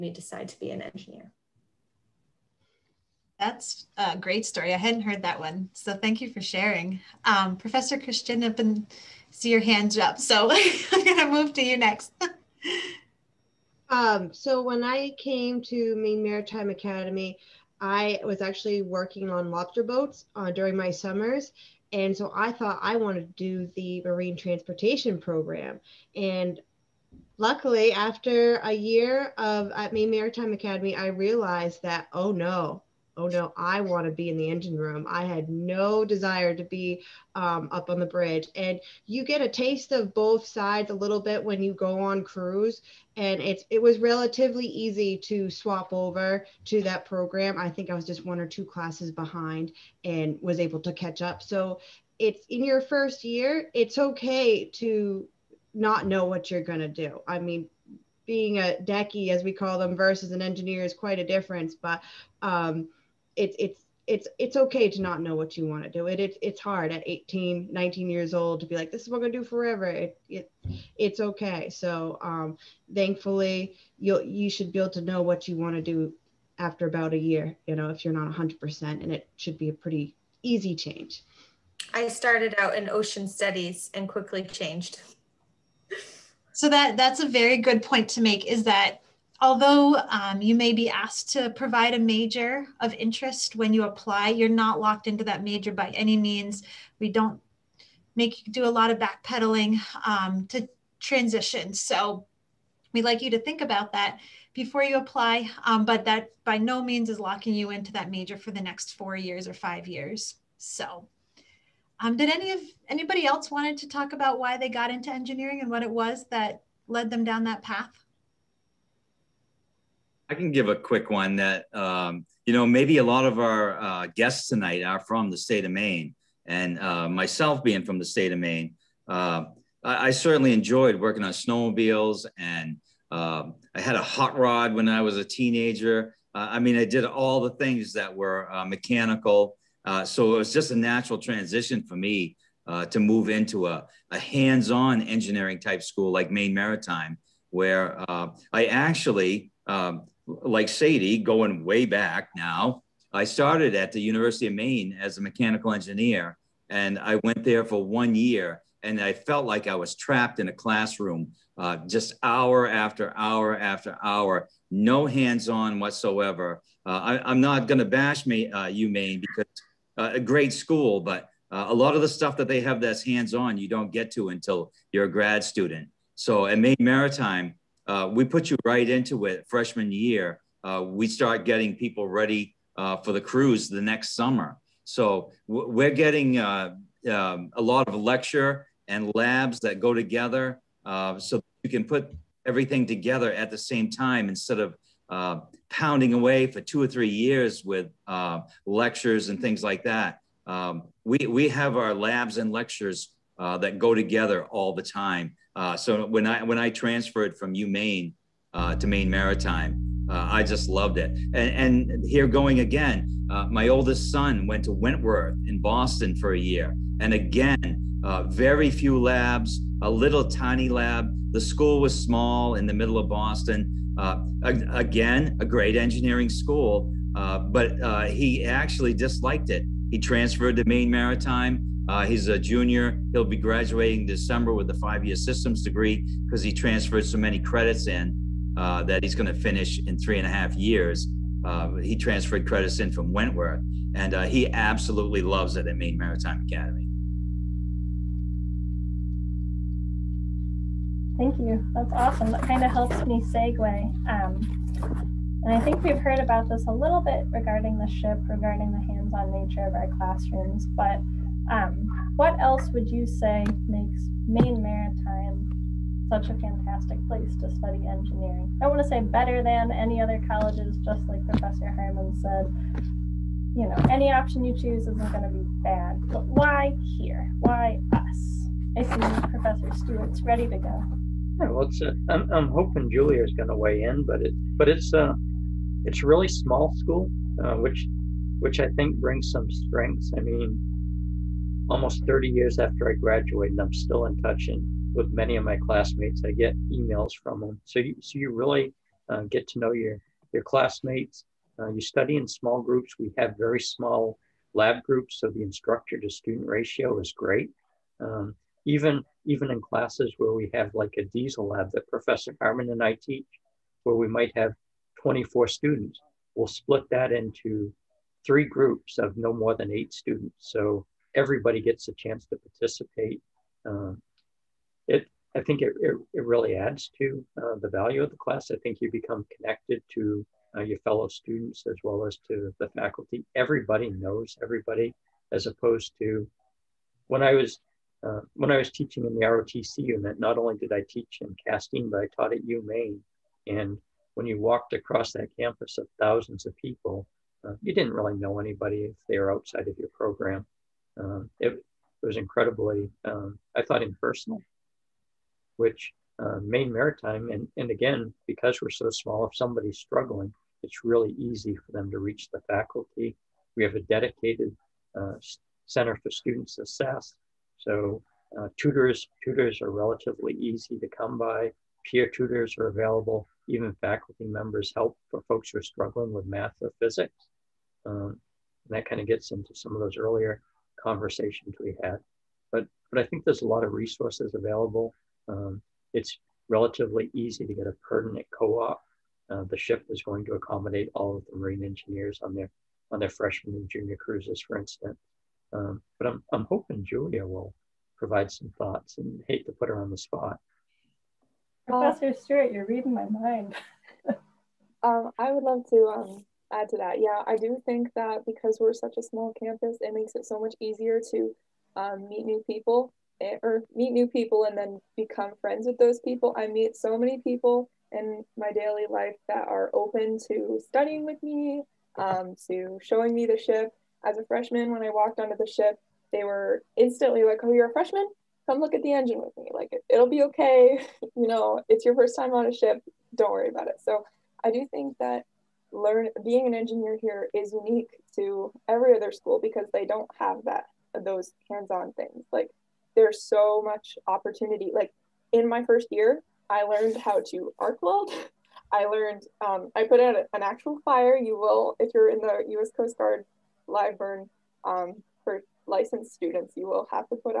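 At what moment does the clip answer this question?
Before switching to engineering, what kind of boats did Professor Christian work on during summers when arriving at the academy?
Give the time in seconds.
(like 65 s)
19 s.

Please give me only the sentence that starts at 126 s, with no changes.
And uh, myself being from the state of Maine, uh, I, I, certainly enjoyed working on snowmobiles.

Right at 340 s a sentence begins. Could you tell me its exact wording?
Not only did I teach in Castine, but I taught at UMaine.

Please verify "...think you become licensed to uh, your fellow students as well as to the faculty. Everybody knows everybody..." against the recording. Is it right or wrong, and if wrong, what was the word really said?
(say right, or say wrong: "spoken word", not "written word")
wrong: "connected", not "licensed".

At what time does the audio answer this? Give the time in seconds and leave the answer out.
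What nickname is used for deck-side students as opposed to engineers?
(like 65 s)
58 s.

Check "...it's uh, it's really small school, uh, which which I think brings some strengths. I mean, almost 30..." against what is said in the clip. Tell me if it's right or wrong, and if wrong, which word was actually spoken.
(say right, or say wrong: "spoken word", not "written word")
right.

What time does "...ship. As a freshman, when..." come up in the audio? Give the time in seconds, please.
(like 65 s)
423 s.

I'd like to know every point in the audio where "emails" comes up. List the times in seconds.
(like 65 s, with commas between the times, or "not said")
296 s.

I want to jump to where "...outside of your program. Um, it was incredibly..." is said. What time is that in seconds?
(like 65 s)
349 s.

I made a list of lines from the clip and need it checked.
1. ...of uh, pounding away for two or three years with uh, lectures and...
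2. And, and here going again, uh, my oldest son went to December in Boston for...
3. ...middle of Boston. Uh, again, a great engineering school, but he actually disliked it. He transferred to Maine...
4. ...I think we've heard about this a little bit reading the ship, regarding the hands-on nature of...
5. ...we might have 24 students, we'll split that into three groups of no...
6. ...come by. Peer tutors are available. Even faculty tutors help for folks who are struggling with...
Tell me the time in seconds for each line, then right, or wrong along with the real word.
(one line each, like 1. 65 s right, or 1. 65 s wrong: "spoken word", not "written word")
1. 194 s right
2. 211 s wrong: "Wentworth", not "December"
3. 222 s right
4. 255 s wrong: "regarding", not "reading"
5. 313 s right
6. 370 s wrong: "members", not "tutors".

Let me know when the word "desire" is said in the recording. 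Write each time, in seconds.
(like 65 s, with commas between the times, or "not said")
36 s.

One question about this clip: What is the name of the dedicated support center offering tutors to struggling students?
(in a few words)
Center for Student Success.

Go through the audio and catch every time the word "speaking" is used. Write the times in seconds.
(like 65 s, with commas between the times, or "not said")
not said.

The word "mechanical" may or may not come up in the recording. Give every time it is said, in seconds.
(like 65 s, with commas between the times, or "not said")
138 s, 155 s.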